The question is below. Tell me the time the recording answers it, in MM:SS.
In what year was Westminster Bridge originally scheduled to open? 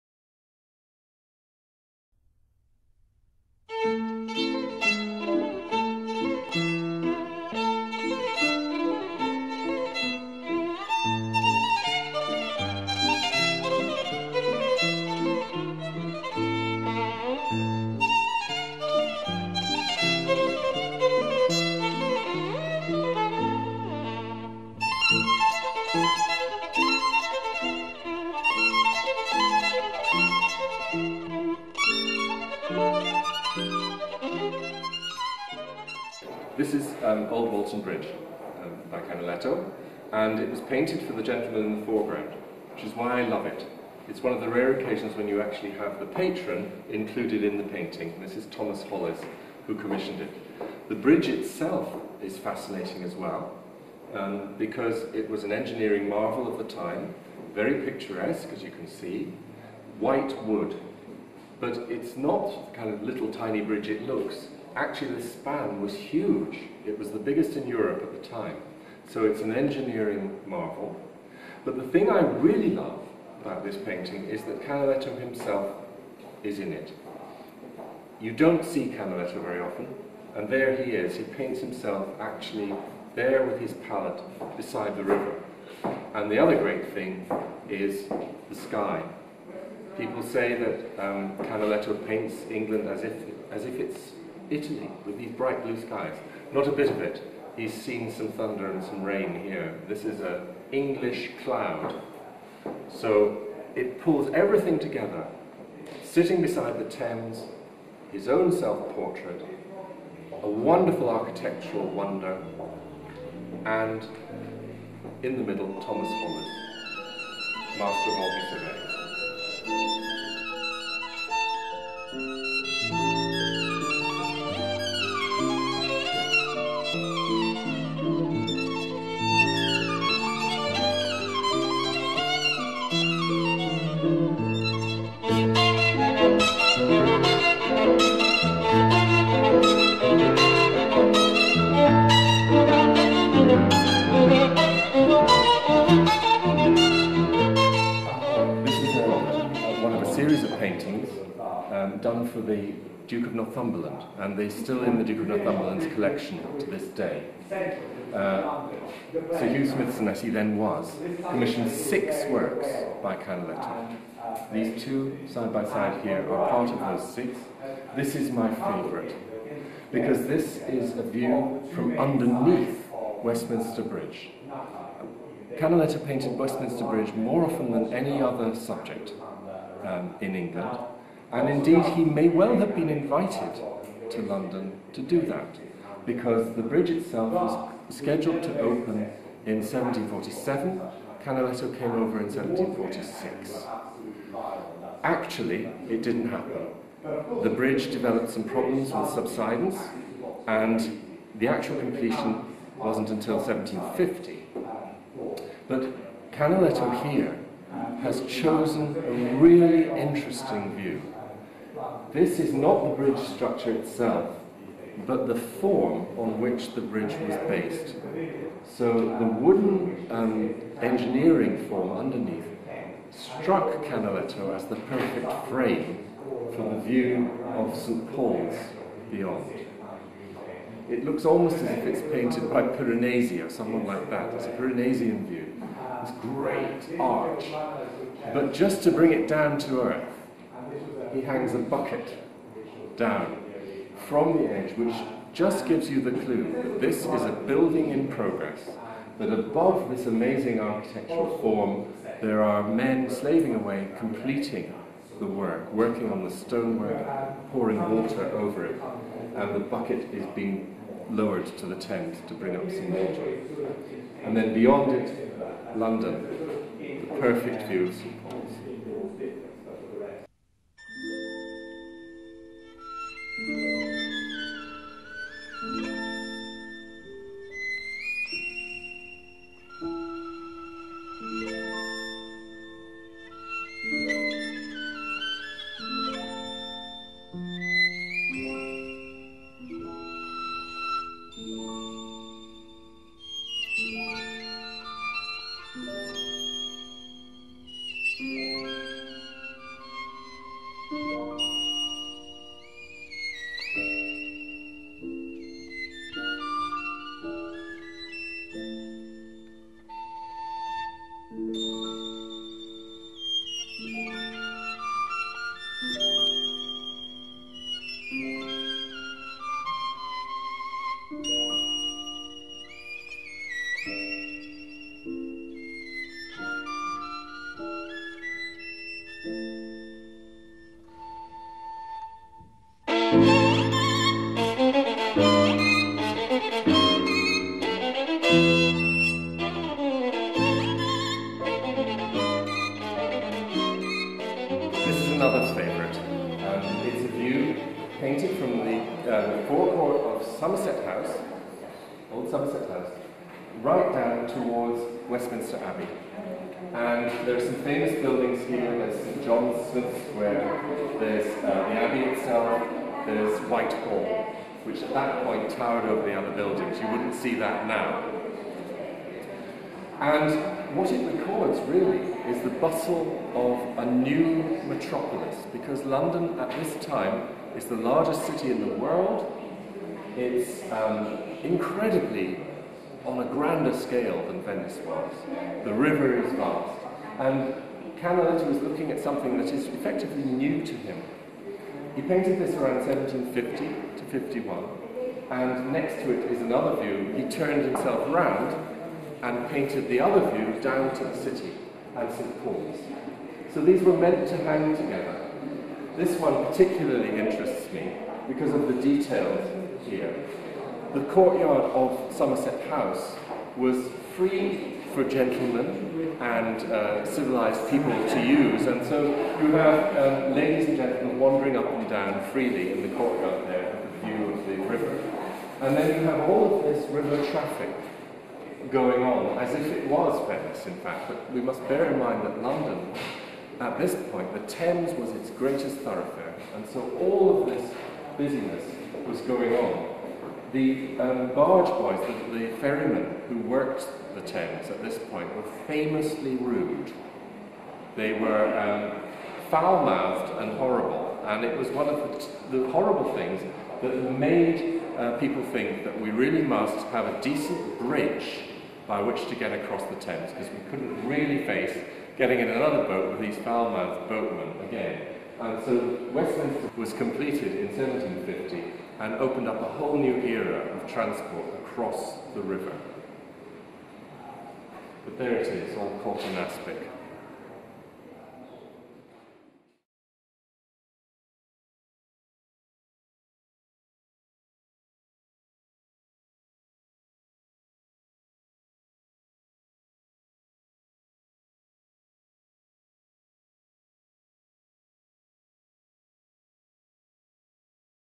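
03:09.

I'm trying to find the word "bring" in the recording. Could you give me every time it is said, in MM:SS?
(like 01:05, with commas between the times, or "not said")
03:58, 04:22.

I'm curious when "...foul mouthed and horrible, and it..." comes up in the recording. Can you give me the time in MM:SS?
07:29.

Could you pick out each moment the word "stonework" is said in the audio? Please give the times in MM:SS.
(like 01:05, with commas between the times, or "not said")
04:16.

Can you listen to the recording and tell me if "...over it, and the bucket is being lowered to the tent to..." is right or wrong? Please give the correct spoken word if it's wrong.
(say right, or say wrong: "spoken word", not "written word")
right.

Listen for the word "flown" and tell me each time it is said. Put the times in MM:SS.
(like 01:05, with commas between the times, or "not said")
not said.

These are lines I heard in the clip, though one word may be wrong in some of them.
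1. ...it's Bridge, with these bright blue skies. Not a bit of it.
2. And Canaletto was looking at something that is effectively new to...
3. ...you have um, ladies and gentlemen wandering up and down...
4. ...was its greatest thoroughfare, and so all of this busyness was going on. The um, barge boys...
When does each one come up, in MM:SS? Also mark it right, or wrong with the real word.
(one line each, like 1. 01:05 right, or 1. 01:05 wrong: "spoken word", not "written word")
1. 01:33 wrong: "Italy", not "Bridge"
2. 06:27 right
3. 06:59 right
4. 07:14 right.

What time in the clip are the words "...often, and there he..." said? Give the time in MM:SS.
01:19.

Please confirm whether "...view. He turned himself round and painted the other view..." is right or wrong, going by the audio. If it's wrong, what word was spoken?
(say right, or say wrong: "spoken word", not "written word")
right.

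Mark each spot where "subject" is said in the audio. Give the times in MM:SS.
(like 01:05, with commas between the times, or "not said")
02:58.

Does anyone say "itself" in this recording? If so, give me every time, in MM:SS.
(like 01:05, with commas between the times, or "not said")
00:51, 03:06, 03:33, 06:02.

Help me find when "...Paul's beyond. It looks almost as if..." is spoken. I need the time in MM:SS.
03:48.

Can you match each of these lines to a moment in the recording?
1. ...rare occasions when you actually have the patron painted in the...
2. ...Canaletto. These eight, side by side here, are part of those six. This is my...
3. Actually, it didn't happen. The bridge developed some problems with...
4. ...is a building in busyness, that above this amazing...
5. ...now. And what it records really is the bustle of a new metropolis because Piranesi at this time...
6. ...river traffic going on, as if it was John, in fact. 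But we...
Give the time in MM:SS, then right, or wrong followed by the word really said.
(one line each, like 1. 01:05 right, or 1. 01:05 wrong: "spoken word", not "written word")
1. 00:44 wrong: "included", not "painted"
2. 02:43 wrong: "two", not "eight"
3. 03:15 right
4. 04:07 wrong: "progress", not "busyness"
5. 06:07 wrong: "London", not "Piranesi"
6. 07:06 wrong: "Venice", not "John".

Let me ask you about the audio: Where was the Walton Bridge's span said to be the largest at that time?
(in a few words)
Europe.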